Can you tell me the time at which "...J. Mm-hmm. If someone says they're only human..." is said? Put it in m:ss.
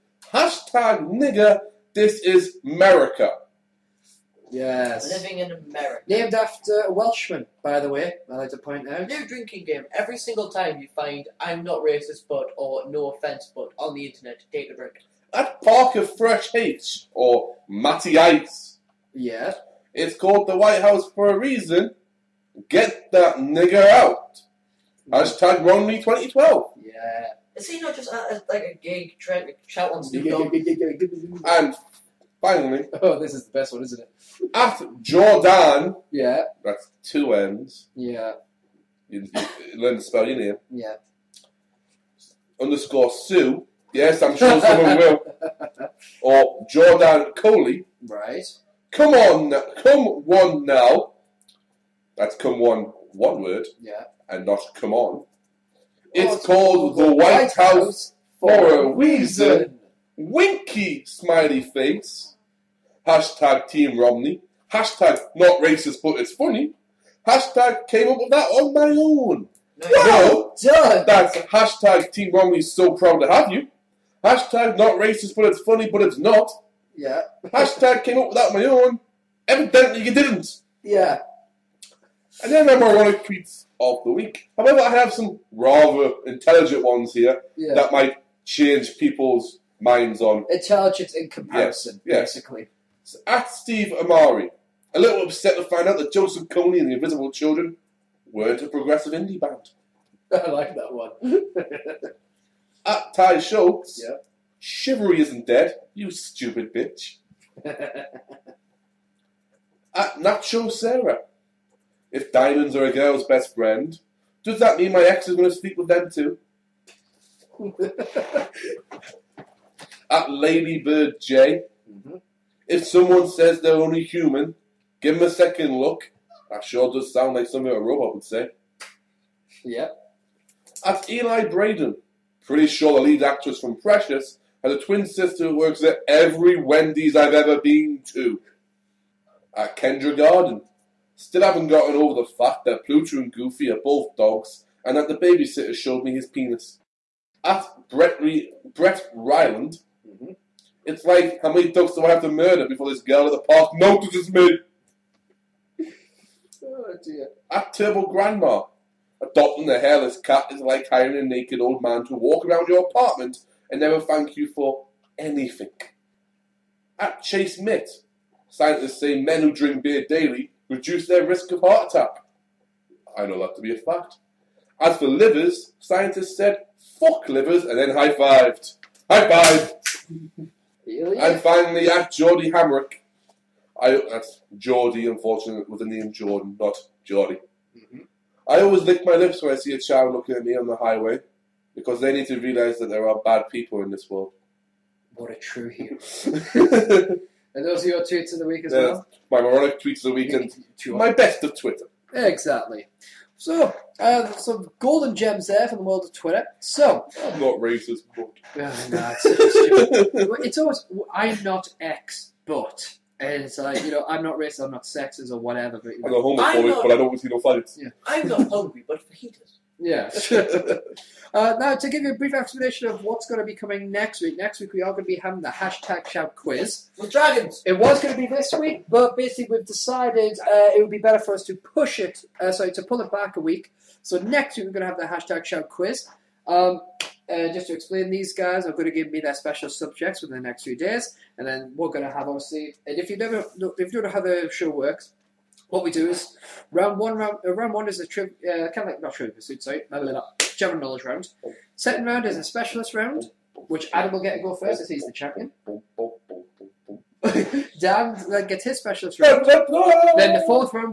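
2:01.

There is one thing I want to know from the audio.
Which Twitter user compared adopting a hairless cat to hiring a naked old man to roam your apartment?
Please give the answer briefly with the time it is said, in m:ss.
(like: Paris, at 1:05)
Turbo Grandma, at 2:37.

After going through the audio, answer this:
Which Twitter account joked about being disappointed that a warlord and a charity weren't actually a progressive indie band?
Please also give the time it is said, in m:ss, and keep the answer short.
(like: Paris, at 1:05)
Steve Amari, at 1:33.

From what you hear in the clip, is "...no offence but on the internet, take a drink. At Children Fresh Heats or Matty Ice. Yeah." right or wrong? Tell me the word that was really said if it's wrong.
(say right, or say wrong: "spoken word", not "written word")
wrong: "Parker", not "Children".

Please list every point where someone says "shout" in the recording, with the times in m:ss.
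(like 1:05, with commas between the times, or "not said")
0:29, 3:46, 3:55.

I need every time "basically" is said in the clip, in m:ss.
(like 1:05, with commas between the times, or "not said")
1:32, 3:49.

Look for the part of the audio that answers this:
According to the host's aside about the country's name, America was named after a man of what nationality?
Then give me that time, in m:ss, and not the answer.
0:06.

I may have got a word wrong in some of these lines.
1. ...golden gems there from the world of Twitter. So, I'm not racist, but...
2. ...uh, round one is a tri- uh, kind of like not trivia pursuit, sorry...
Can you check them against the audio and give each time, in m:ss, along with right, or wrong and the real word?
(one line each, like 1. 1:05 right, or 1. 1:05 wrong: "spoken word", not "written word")
1. 3:24 right
2. 4:07 right.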